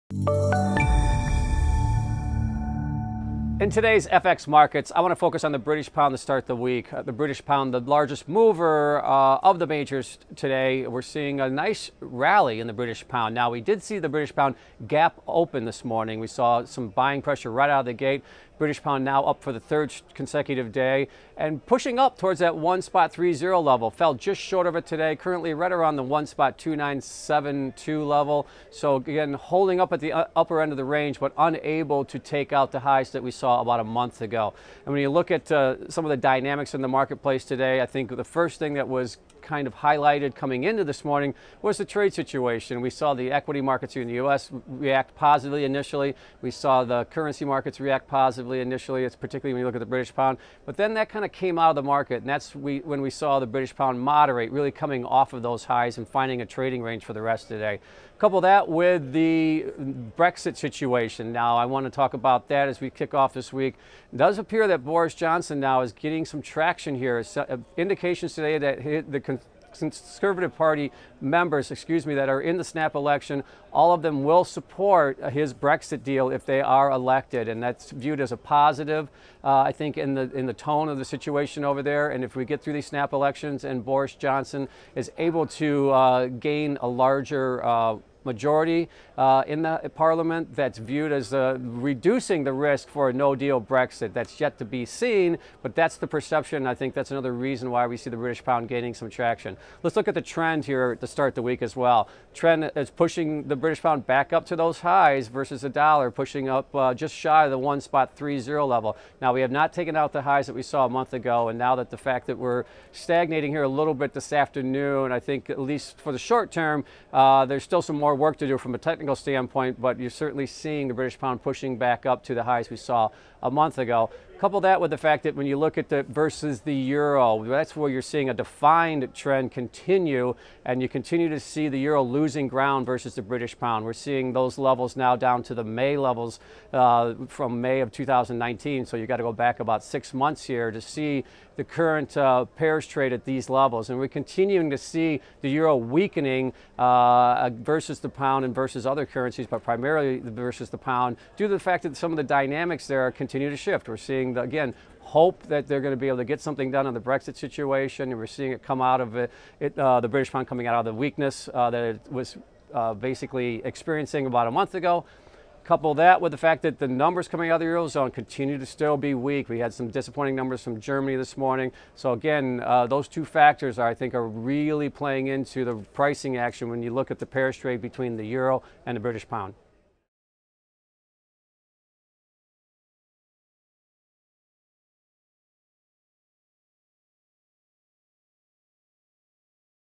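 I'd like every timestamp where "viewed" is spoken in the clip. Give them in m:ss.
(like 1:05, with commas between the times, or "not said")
1:17, 1:30.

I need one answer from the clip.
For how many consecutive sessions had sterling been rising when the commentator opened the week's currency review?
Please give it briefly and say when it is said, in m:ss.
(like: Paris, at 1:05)
3, at 0:19.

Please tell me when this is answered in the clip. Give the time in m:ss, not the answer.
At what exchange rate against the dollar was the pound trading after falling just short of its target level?
0:26.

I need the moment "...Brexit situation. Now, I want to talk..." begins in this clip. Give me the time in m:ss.
1:00.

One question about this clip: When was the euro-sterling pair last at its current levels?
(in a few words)
May 2019.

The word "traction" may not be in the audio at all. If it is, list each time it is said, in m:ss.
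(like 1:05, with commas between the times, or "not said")
1:06, 1:39.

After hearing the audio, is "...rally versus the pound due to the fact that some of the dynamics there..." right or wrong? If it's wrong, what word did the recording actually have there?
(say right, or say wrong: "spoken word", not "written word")
wrong: "primarily", not "rally".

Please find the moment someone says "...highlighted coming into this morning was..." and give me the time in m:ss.
0:39.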